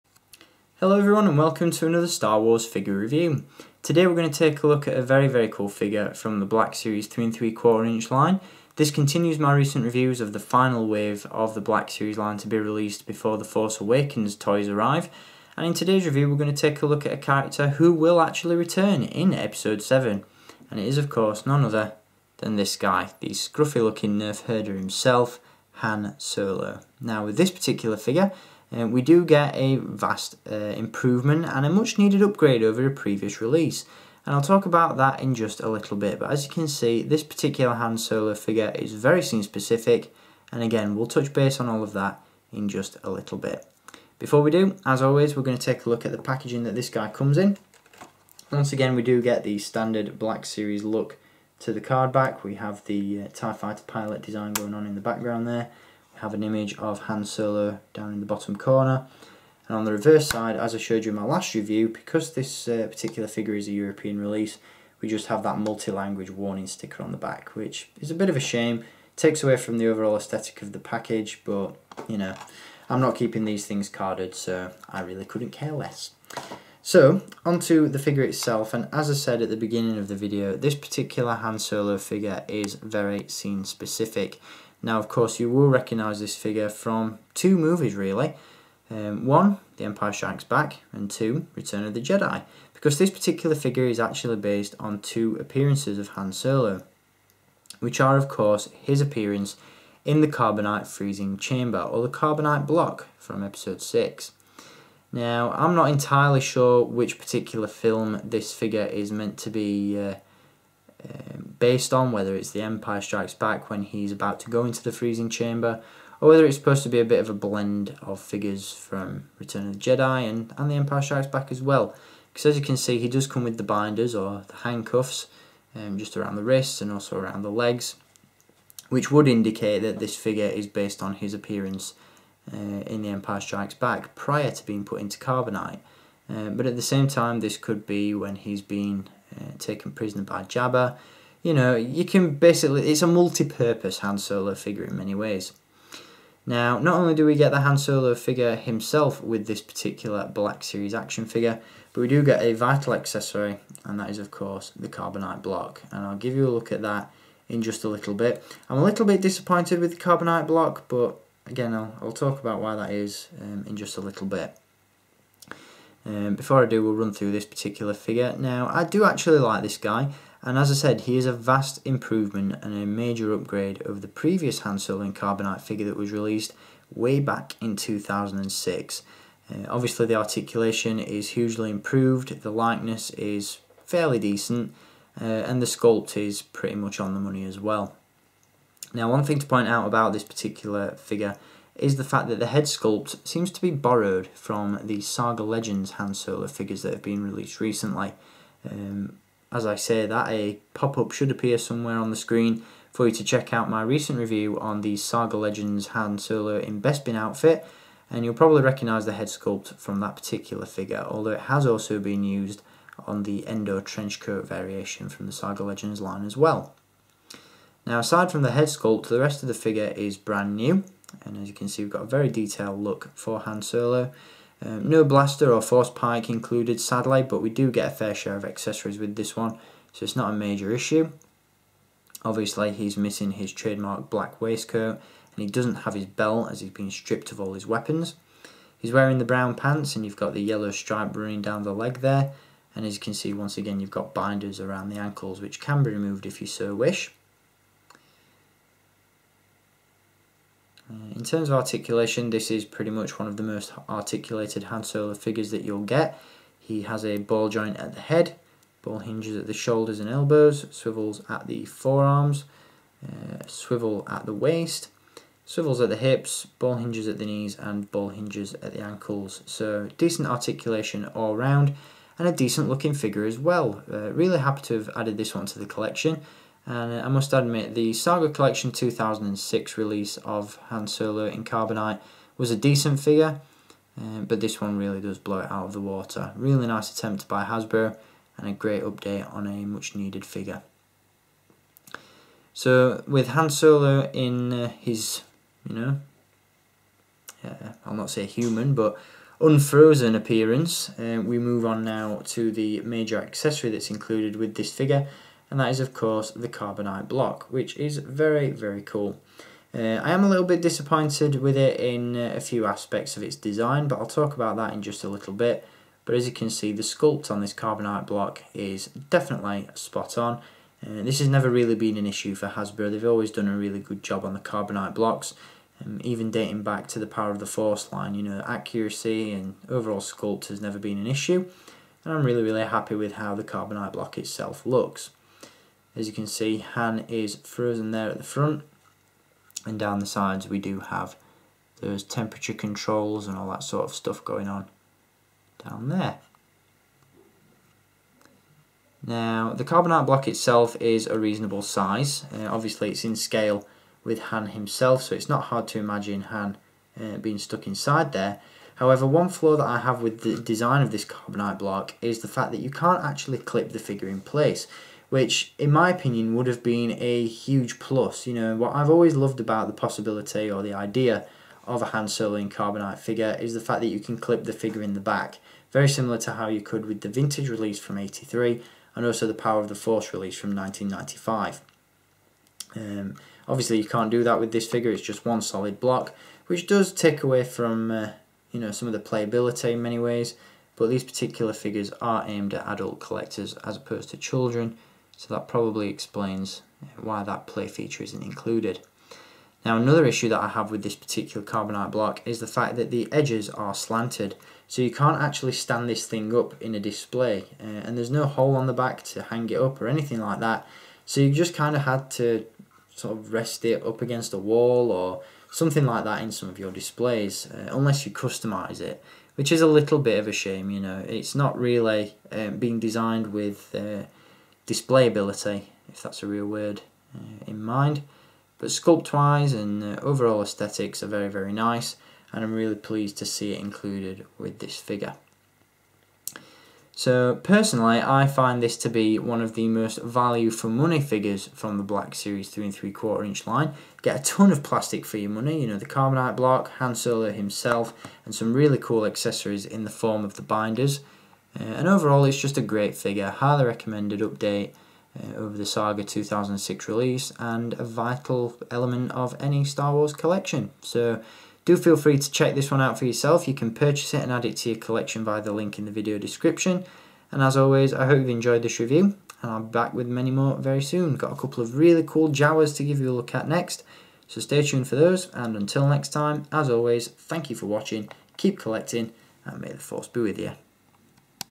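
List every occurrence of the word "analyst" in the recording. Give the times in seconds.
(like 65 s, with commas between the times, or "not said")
not said.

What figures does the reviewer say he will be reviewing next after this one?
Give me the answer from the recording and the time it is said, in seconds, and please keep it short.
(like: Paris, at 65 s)
Jawas, at 472 s.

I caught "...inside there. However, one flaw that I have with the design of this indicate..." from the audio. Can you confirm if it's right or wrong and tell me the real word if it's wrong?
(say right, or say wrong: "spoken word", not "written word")
wrong: "carbonite", not "indicate".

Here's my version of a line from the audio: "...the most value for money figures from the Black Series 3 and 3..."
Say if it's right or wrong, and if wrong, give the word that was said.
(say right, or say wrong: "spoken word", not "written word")
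right.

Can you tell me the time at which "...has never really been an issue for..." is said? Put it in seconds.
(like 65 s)
321 s.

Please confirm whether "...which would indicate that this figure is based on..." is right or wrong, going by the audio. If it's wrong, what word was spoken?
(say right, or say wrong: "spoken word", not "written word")
right.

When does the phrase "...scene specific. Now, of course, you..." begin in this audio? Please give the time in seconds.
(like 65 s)
83 s.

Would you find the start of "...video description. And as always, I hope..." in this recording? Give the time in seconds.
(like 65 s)
465 s.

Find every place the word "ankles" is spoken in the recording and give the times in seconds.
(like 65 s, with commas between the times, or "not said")
244 s, 268 s.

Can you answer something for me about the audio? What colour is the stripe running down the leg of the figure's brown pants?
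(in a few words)
yellow.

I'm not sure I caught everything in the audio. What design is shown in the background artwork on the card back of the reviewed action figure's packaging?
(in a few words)
TIE Fighter pilot.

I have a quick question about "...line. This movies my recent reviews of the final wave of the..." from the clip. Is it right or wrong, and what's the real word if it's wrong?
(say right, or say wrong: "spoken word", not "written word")
wrong: "continues", not "movies".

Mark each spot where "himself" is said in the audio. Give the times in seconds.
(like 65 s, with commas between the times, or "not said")
24 s, 148 s, 354 s, 447 s.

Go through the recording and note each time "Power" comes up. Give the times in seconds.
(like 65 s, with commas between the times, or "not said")
327 s, 379 s.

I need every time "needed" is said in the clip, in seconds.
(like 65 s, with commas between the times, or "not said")
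31 s, 289 s.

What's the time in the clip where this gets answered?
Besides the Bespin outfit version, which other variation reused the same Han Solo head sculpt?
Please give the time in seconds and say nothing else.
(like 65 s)
213 s.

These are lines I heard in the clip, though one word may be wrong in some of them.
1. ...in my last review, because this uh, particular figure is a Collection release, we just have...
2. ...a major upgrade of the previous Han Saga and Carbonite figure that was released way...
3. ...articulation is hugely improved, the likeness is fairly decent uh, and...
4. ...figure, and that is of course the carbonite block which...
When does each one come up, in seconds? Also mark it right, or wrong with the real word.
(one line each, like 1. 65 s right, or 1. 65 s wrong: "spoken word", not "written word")
1. 61 s wrong: "European", not "Collection"
2. 172 s wrong: "Solo", not "Saga"
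3. 180 s right
4. 304 s right.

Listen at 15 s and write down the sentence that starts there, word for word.
And in today's review we're going to take a look at a character who will actually return in episode 7.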